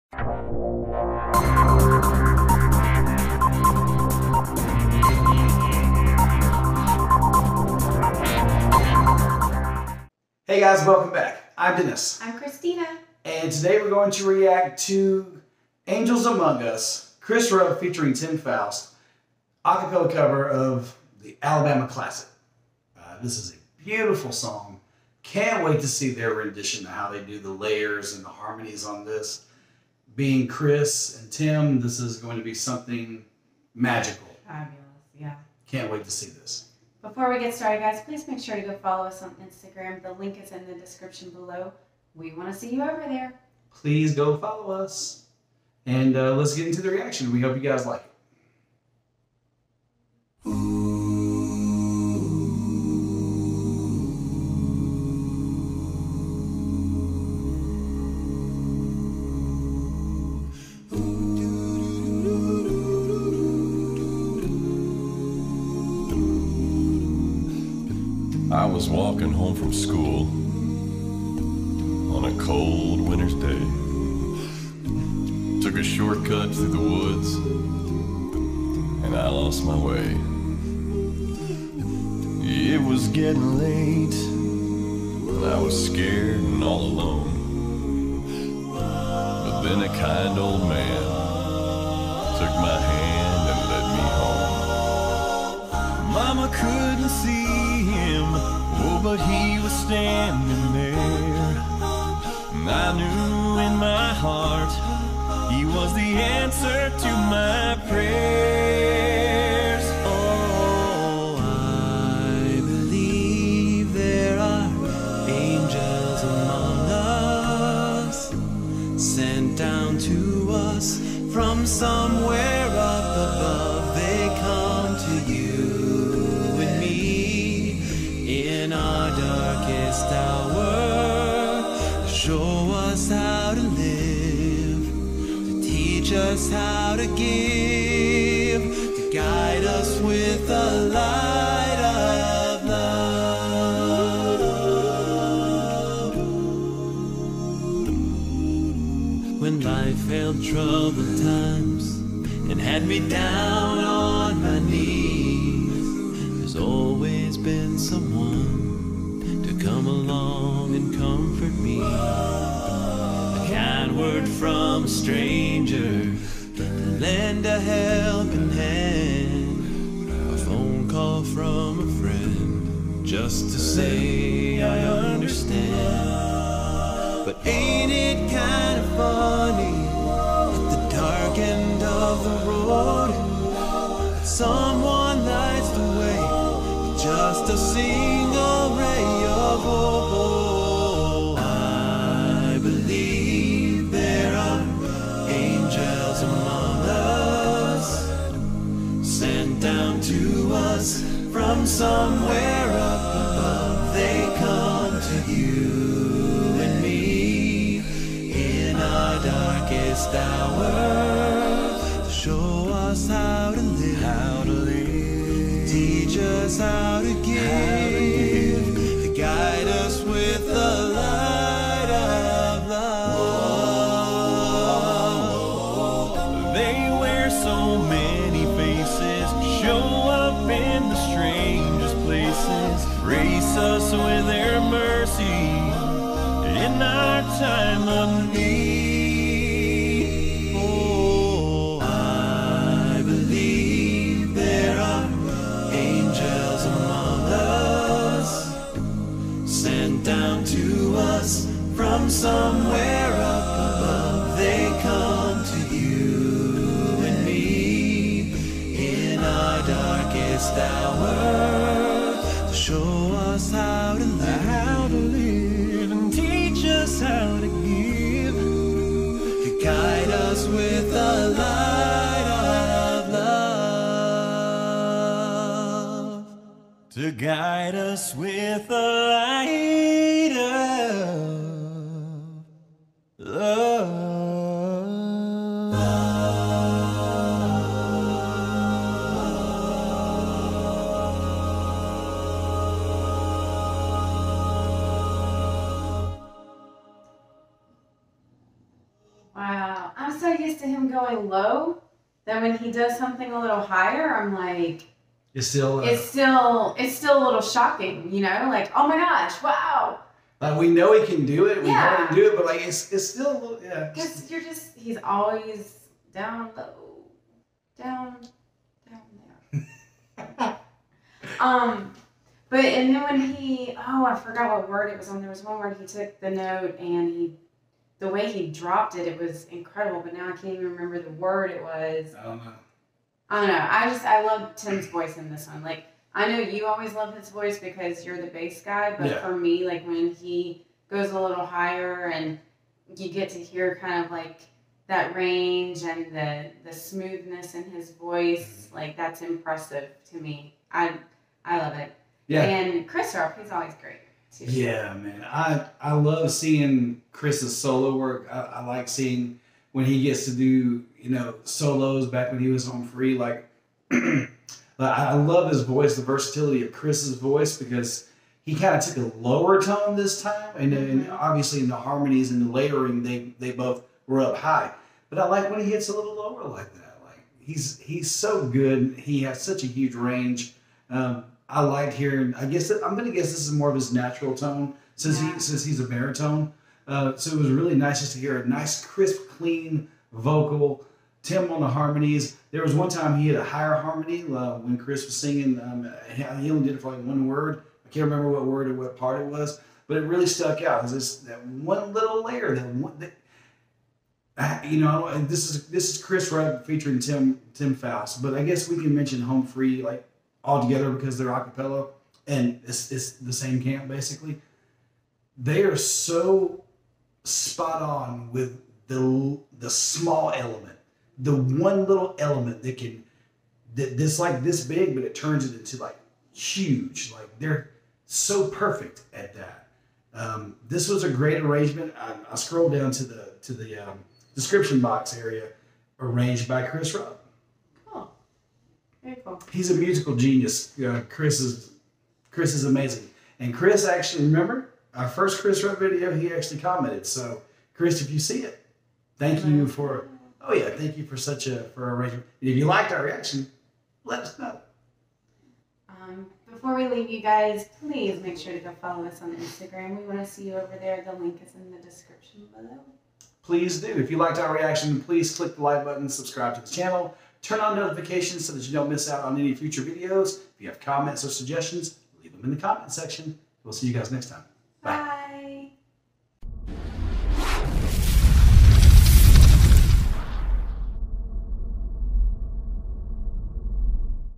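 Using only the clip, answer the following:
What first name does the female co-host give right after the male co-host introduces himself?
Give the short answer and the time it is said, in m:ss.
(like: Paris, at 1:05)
Christina, at 0:12.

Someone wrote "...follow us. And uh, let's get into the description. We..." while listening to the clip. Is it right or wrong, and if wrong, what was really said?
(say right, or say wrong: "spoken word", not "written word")
wrong: "reaction", not "description".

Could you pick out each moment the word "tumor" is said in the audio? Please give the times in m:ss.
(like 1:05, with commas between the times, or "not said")
not said.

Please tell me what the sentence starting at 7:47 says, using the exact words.
Turn on notifications so that you don't miss out on any future videos.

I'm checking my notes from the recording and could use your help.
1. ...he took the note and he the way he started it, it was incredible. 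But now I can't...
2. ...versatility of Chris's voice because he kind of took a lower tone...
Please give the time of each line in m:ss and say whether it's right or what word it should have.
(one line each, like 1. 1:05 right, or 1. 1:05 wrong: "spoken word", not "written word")
1. 5:25 wrong: "dropped", not "started"
2. 6:06 right.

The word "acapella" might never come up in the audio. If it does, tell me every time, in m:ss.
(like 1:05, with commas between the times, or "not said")
0:19, 6:51.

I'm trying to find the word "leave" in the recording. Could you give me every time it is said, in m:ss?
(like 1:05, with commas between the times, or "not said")
7:36, 7:52.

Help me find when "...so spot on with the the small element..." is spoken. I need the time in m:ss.
6:55.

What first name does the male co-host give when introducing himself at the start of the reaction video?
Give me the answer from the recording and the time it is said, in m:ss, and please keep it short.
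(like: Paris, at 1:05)
Dennis, at 0:11.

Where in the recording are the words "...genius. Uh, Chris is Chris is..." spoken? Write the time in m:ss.
7:20.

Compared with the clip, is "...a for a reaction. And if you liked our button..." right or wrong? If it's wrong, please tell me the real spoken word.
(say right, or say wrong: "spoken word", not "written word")
wrong: "reaction", not "button".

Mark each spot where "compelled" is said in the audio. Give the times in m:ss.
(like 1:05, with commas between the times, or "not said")
not said.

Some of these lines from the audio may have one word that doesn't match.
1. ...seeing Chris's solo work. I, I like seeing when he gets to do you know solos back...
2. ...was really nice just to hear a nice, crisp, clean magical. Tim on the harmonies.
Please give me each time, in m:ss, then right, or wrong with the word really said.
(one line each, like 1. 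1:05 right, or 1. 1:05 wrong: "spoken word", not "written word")
1. 5:56 right
2. 6:27 wrong: "vocal", not "magical".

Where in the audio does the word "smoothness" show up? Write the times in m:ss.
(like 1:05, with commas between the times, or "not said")
5:46.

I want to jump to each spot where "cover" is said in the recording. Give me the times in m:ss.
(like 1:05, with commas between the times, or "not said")
0:20.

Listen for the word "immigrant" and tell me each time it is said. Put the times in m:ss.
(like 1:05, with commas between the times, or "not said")
not said.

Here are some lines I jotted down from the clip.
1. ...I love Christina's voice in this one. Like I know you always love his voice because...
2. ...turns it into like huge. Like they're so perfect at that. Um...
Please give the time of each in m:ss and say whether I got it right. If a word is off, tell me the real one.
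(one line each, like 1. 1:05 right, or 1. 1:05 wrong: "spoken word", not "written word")
1. 5:34 wrong: "Tim", not "Christina"
2. 7:05 right.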